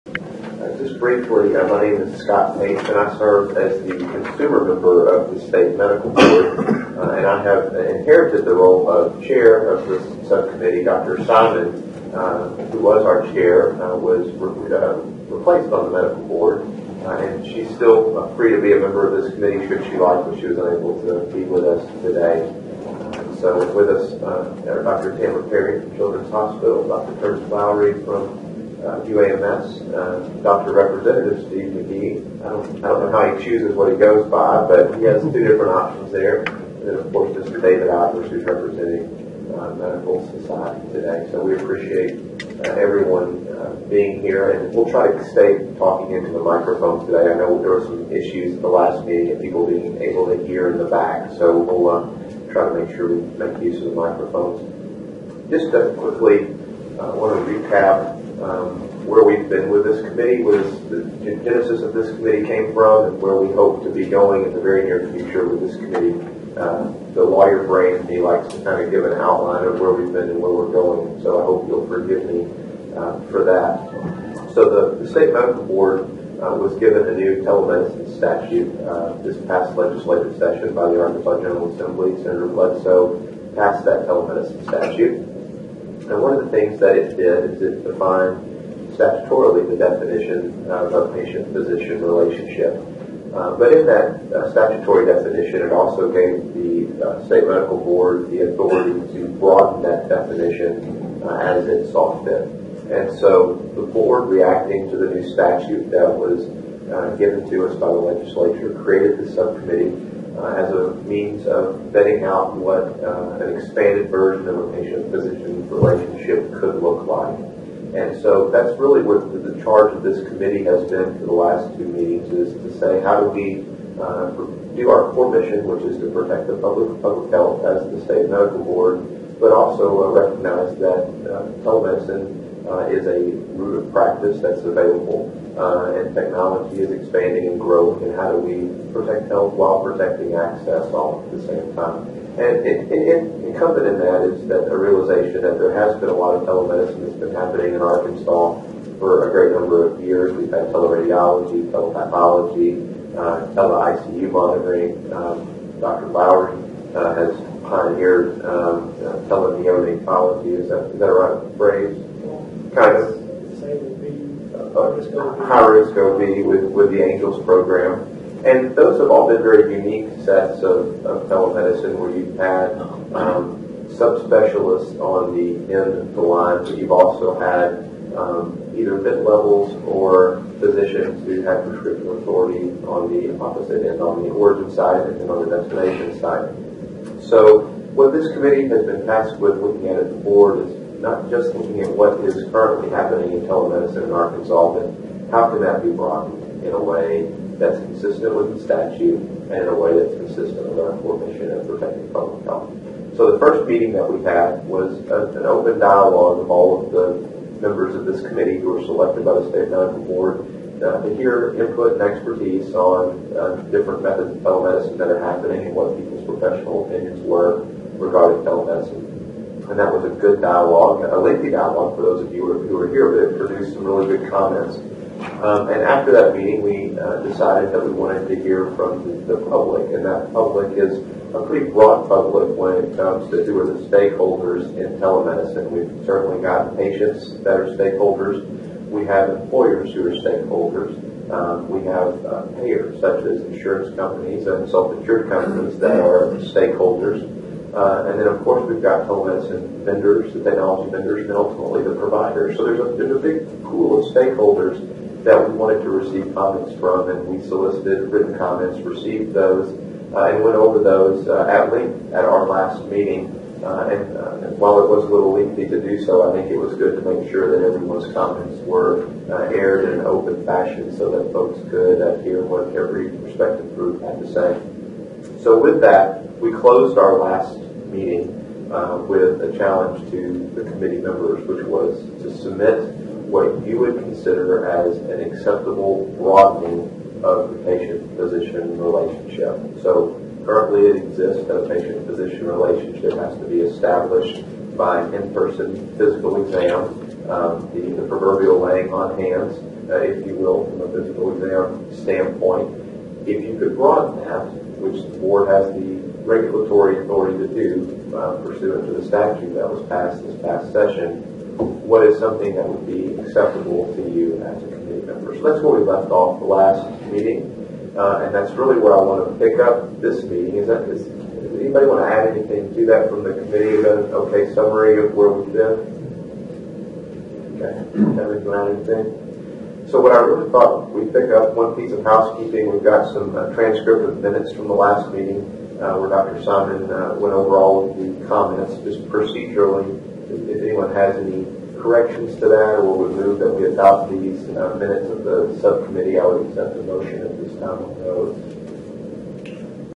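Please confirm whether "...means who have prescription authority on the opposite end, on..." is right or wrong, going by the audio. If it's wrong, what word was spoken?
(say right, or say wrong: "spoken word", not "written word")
wrong: "physicians", not "means".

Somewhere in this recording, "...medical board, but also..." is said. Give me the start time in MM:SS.
02:08.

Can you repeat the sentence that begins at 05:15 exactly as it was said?
So that's where we left off the last meeting, uh, and that's really where I want to pick up this meeting.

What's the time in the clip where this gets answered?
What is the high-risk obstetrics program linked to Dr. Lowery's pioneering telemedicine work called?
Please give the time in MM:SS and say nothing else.
02:47.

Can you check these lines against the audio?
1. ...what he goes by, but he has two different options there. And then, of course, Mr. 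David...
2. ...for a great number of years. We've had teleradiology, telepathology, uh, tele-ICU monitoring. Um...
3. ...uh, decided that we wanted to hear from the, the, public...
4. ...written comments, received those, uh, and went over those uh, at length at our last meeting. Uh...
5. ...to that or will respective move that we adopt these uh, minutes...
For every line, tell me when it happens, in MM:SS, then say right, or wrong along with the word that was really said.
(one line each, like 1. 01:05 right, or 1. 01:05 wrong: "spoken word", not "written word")
1. 00:33 right
2. 02:28 right
3. 03:46 right
4. 04:18 right
5. 05:42 wrong: "remove", not "respective".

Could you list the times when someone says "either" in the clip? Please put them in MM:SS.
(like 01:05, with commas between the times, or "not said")
02:58.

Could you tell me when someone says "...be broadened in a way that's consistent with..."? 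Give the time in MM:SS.
03:15.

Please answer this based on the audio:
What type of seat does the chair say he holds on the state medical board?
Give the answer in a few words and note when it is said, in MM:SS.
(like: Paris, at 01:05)
consumer member, at 00:03.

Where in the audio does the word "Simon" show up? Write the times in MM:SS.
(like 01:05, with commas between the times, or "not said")
00:11, 05:36.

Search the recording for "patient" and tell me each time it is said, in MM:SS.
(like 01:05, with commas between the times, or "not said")
01:31, 01:54, 03:56, 04:47, 04:51.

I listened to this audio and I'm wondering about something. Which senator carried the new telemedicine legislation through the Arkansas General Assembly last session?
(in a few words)
Senator Bledsoe.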